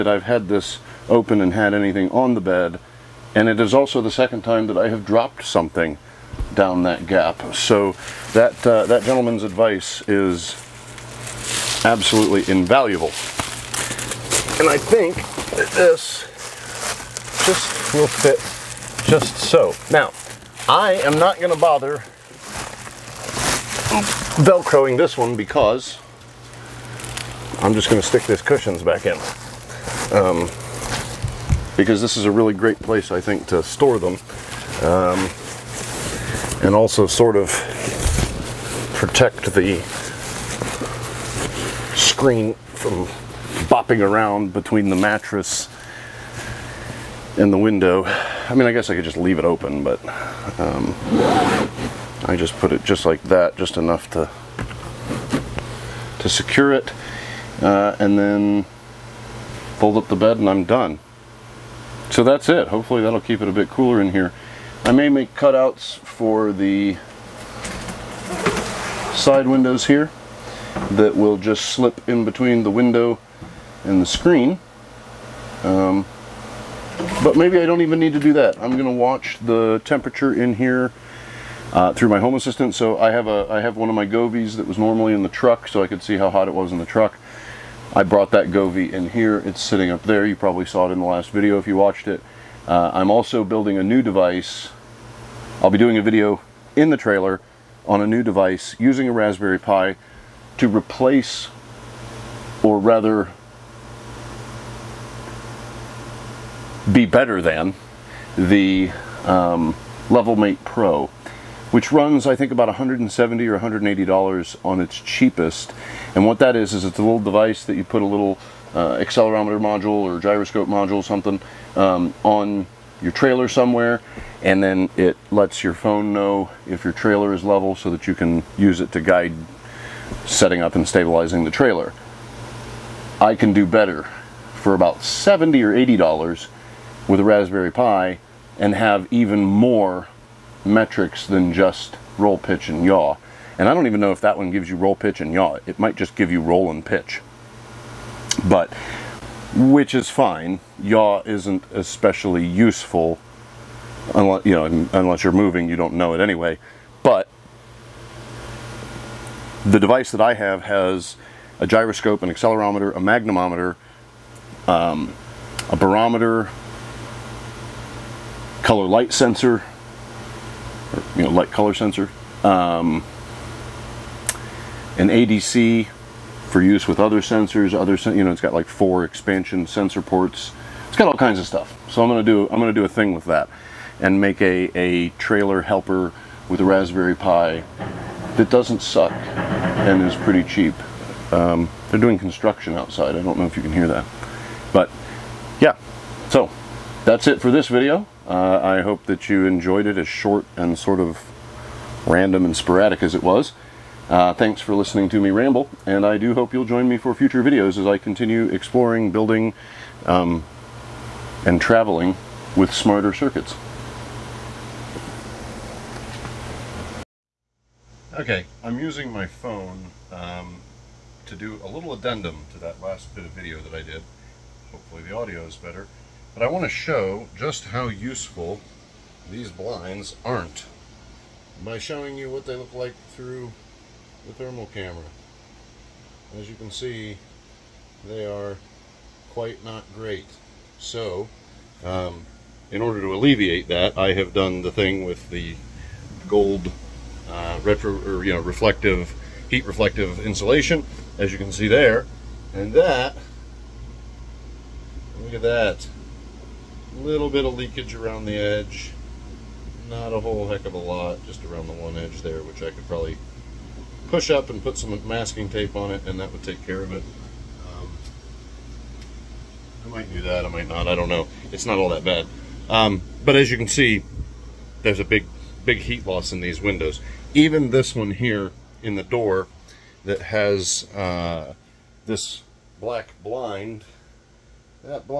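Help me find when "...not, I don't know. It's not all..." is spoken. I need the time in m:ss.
4:30.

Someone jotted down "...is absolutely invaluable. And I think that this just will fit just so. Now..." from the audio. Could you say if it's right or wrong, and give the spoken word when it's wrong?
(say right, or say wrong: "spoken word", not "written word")
right.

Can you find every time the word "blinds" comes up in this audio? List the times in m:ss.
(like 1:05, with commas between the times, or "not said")
3:49, 4:43.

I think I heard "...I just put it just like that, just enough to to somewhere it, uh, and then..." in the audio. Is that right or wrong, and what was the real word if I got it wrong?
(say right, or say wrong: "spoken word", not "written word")
wrong: "secure", not "somewhere".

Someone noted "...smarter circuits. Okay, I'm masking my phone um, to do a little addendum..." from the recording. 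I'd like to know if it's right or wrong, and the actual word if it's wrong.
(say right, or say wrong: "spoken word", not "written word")
wrong: "using", not "masking".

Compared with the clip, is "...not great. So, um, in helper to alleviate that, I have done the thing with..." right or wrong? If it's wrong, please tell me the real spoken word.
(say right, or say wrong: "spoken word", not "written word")
wrong: "order", not "helper".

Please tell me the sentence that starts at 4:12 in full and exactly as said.
And that, look at that little bit of leakage around the edge.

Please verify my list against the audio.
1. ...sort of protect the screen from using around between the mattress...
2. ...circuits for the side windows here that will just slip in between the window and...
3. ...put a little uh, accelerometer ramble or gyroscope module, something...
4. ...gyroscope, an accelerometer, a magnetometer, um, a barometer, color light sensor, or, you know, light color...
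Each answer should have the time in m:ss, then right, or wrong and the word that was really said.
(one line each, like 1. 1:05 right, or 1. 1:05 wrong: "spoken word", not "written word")
1. 0:37 wrong: "bopping", not "using"
2. 1:05 wrong: "cutouts", not "circuits"
3. 1:57 wrong: "module", not "ramble"
4. 2:41 right.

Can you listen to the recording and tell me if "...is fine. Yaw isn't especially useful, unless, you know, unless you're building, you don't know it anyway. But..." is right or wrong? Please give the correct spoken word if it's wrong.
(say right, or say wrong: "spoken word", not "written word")
wrong: "moving", not "building".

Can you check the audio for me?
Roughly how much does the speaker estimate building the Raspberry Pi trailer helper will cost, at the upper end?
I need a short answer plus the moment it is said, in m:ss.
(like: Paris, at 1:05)
$80, at 2:15.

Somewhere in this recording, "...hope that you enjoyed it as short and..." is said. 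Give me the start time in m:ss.
3:18.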